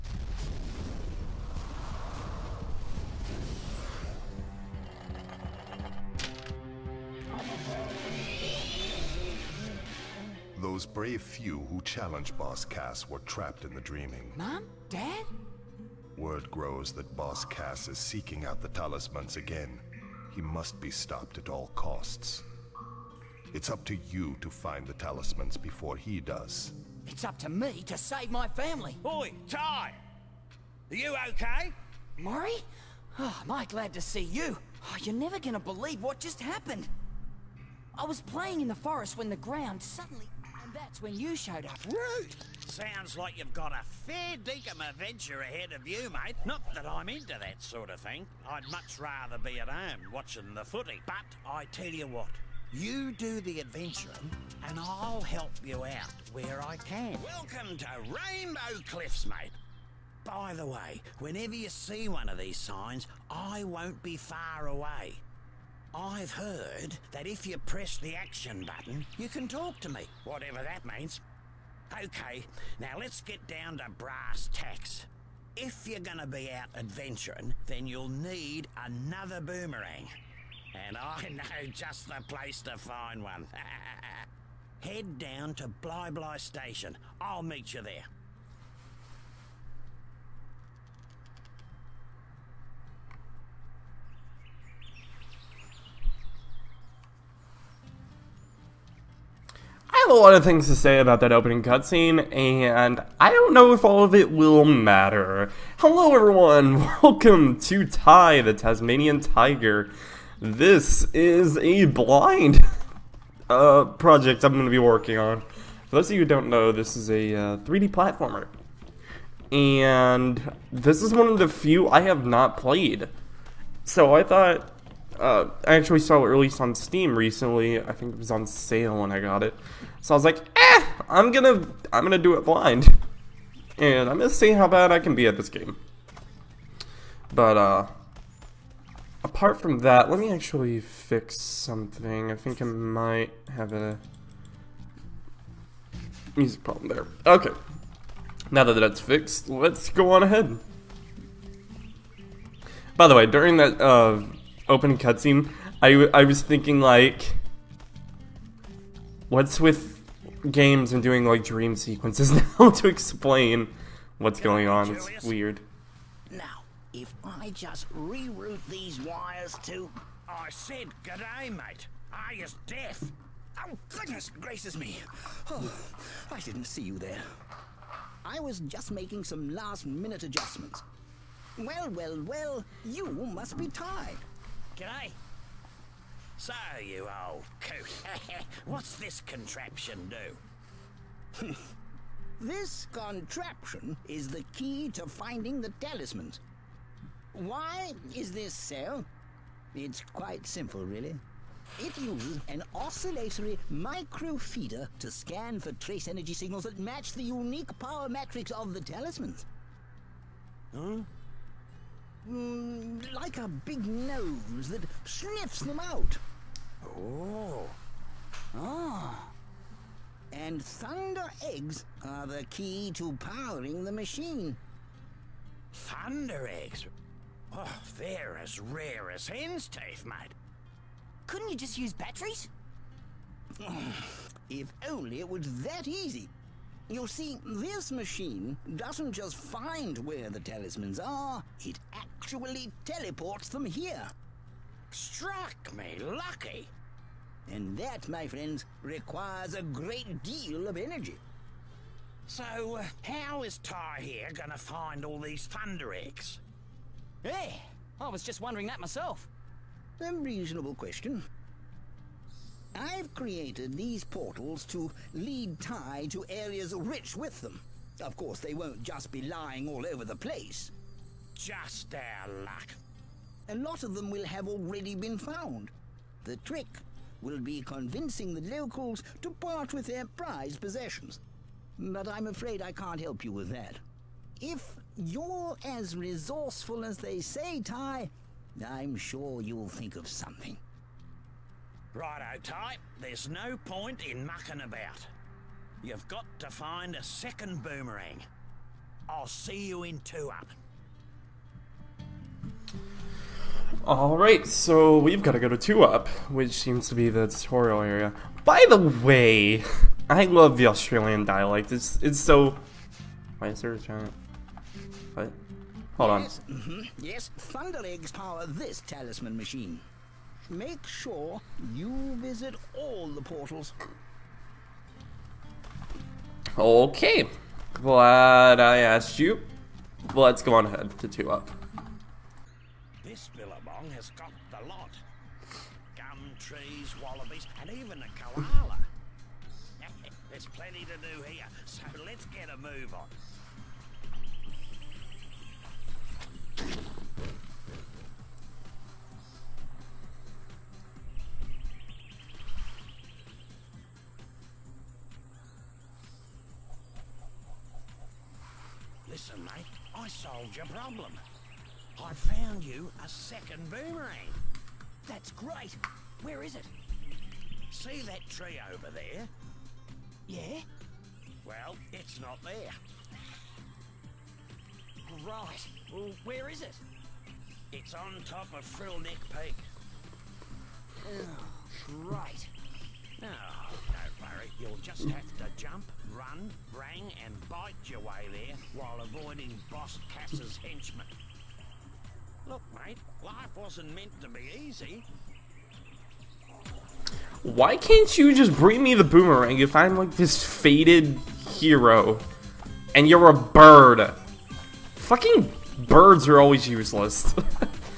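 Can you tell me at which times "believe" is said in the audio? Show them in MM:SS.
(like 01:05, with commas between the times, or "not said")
00:35.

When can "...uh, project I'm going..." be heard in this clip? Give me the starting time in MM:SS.
01:53.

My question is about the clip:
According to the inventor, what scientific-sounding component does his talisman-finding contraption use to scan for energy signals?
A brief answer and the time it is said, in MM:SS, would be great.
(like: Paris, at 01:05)
oscillatory microfeeder, at 03:22.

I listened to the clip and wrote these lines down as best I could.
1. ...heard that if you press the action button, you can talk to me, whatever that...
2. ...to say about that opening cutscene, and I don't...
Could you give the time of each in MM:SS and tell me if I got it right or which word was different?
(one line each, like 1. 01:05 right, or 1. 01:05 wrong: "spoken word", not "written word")
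1. 01:06 right
2. 01:40 right.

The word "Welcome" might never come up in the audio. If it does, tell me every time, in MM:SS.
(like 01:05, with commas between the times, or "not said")
00:57, 01:47.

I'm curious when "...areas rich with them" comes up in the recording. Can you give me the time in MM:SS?
04:26.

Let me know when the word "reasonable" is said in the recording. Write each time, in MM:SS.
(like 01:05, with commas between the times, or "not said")
04:20.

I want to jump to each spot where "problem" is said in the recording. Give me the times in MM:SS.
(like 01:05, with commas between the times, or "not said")
02:26, 06:00.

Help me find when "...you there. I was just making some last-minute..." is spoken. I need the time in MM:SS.
02:56.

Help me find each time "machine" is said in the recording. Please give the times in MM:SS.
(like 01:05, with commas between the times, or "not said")
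03:43, 03:57, 05:19.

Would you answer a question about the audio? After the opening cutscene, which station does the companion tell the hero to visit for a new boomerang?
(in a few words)
Bli Bli Station.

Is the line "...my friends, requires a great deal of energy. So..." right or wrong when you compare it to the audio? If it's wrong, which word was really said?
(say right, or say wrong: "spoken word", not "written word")
right.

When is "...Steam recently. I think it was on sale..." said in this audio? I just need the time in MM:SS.
02:06.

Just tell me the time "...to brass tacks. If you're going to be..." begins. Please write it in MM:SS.
01:13.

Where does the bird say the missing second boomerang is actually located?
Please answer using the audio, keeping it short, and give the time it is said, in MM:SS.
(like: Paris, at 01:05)
Frill Neck Peak, at 06:18.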